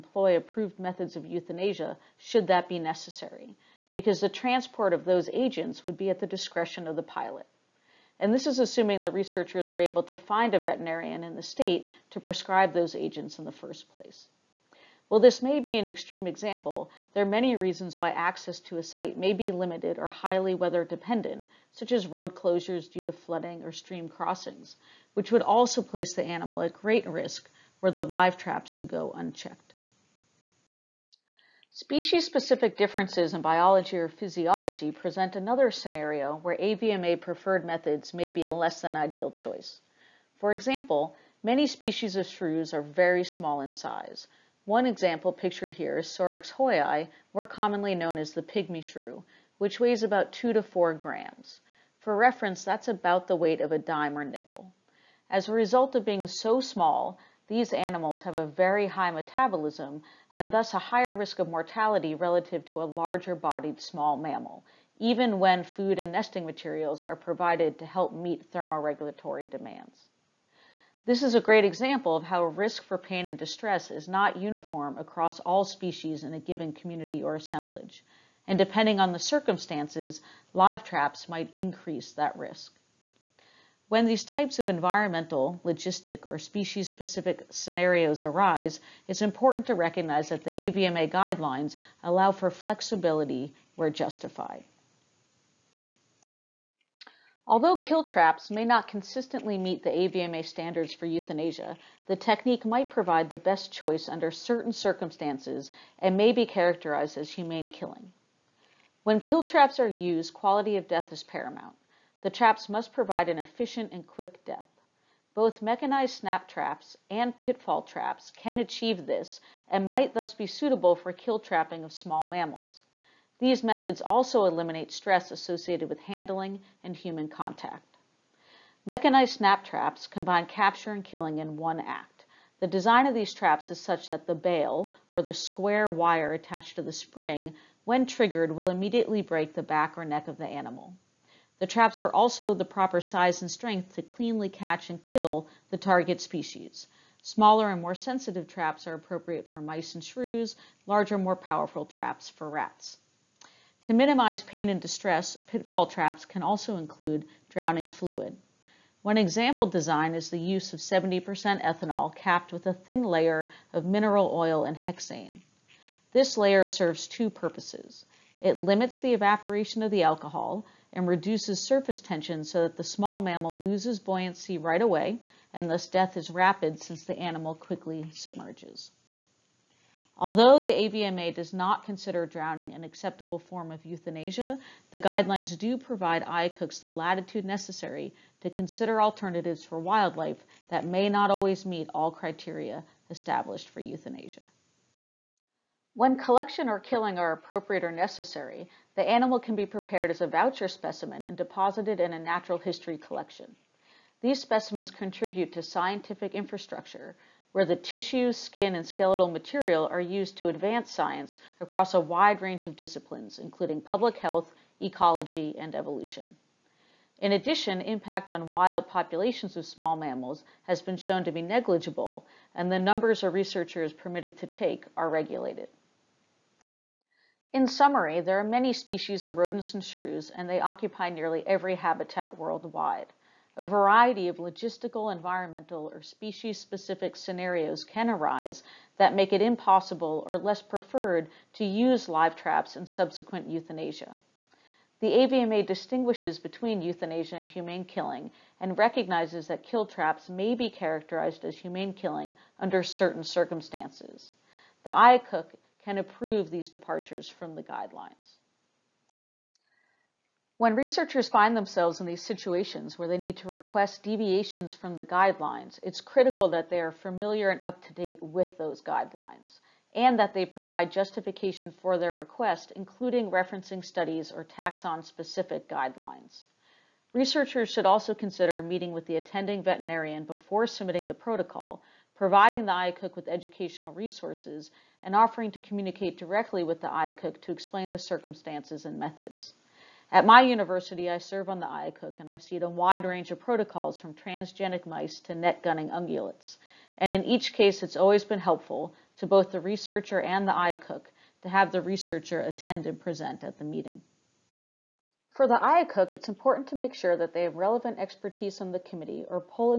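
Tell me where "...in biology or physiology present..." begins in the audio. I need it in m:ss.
0:33.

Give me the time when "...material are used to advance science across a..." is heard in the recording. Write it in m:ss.
3:29.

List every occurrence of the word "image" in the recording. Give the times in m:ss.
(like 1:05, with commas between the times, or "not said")
not said.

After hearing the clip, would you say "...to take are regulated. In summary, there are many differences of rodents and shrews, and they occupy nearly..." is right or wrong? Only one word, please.
wrong.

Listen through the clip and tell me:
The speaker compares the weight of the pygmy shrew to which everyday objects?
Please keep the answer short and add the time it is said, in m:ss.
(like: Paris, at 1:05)
a dime or nickel, at 0:53.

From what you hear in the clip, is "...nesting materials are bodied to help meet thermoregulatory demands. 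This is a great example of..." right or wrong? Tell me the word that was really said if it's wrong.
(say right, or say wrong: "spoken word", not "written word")
wrong: "provided", not "bodied".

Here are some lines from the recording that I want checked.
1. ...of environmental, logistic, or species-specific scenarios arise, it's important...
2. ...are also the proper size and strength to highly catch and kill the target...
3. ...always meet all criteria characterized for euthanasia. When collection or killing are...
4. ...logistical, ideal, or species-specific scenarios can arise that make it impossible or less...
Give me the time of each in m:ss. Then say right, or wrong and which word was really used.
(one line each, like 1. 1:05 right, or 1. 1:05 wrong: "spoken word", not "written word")
1. 1:24 right
2. 2:22 wrong: "cleanly", not "highly"
3. 3:11 wrong: "established", not "characterized"
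4. 3:54 wrong: "environmental", not "ideal".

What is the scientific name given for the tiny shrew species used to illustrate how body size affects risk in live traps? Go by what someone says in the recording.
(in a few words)
Sorex hoyi.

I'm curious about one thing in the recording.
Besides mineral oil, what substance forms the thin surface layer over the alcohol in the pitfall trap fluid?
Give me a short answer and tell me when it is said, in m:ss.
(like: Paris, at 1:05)
hexane, at 2:44.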